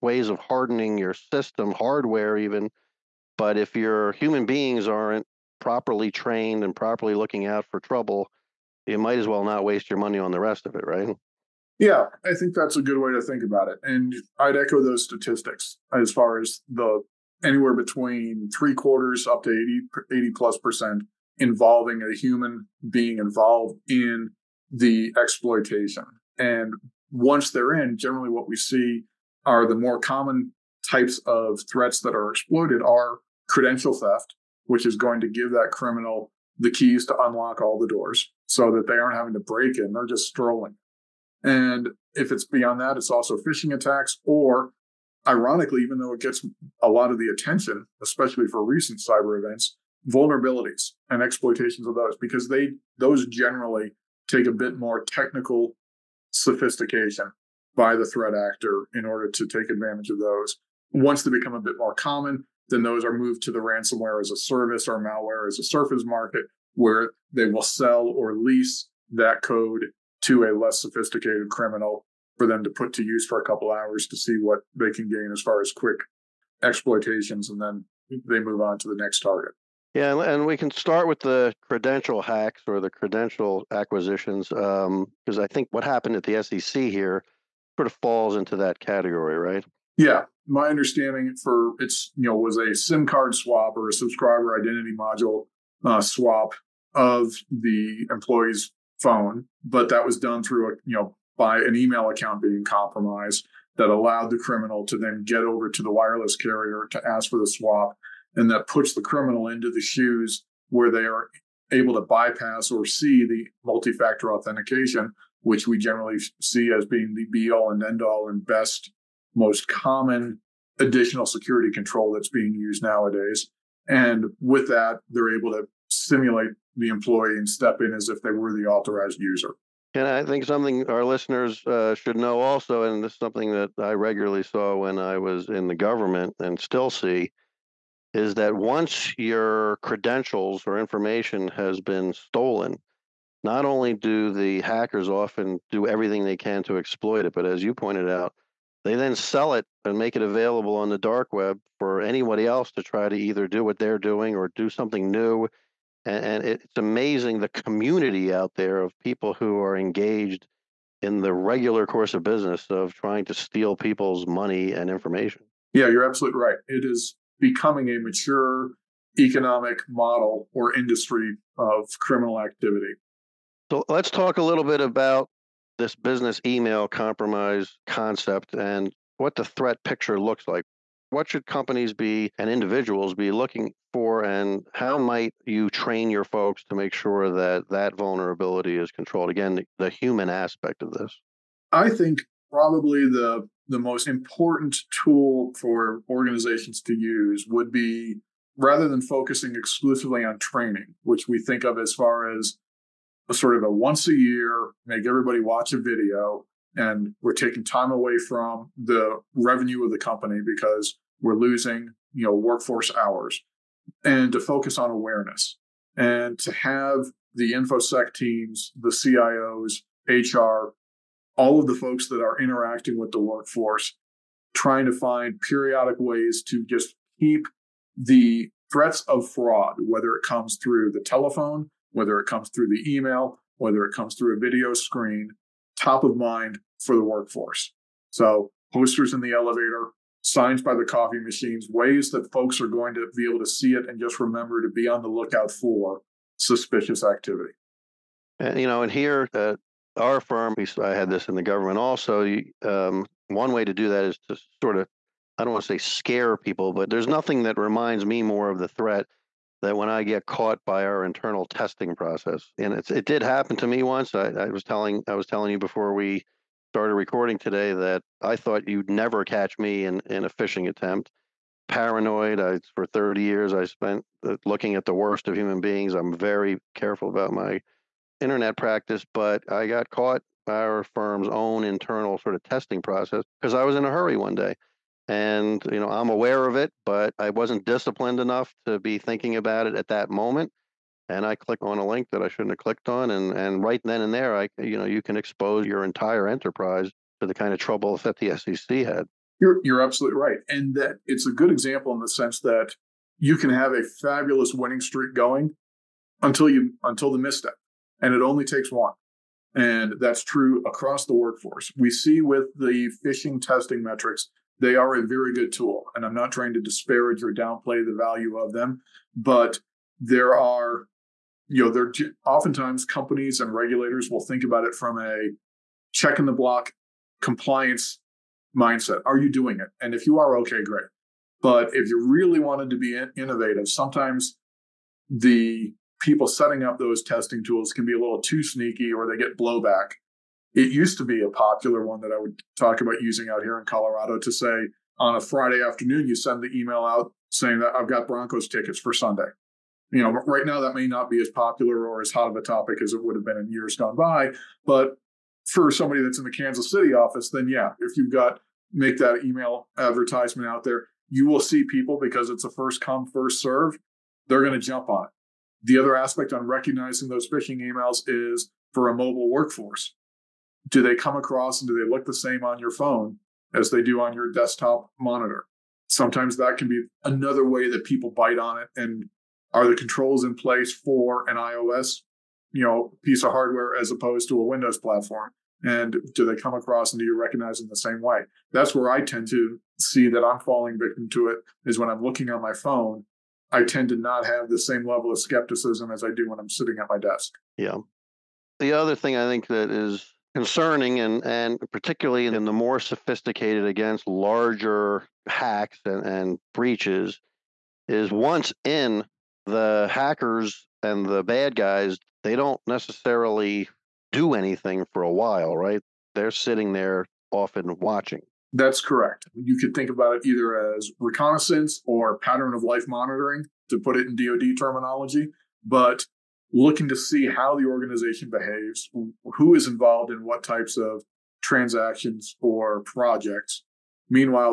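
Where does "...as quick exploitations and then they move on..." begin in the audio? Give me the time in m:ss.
1:15.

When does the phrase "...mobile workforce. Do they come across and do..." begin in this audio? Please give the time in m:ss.
6:08.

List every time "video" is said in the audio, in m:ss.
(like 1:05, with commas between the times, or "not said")
3:25, 3:54.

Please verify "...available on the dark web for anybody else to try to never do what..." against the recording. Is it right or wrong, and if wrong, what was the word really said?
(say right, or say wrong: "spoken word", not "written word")
wrong: "either", not "never".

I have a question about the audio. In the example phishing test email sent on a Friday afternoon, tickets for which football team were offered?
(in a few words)
Broncos.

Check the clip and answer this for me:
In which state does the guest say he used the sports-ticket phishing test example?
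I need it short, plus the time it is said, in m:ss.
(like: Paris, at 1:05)
Colorado, at 5:43.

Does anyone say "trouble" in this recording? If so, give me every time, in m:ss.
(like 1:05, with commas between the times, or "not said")
0:07, 4:57.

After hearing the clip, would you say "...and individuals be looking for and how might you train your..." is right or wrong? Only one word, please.
right.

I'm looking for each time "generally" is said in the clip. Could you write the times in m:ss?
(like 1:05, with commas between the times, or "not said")
0:27, 0:53, 1:55.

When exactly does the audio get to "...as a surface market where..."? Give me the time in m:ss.
1:05.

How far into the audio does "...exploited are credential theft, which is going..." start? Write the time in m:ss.
0:32.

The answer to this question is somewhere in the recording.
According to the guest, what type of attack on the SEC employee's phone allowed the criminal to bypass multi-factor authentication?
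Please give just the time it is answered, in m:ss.
1:32.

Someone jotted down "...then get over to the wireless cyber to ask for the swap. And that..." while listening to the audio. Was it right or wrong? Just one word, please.
wrong.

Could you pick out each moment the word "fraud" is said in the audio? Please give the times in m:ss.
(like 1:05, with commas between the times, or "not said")
3:49.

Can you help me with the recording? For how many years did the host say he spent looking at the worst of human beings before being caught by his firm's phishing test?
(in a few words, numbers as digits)
30.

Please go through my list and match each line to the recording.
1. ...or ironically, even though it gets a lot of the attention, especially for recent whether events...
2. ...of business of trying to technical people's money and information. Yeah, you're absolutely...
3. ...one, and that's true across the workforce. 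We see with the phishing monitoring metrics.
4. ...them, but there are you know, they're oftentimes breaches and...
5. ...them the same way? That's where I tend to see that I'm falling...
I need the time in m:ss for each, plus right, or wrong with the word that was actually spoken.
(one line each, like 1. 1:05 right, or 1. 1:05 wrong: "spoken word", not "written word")
1. 0:44 wrong: "cyber", not "whether"
2. 2:42 wrong: "steal", not "technical"
3. 5:08 wrong: "testing", not "monitoring"
4. 5:18 wrong: "companies", not "breaches"
5. 6:27 right.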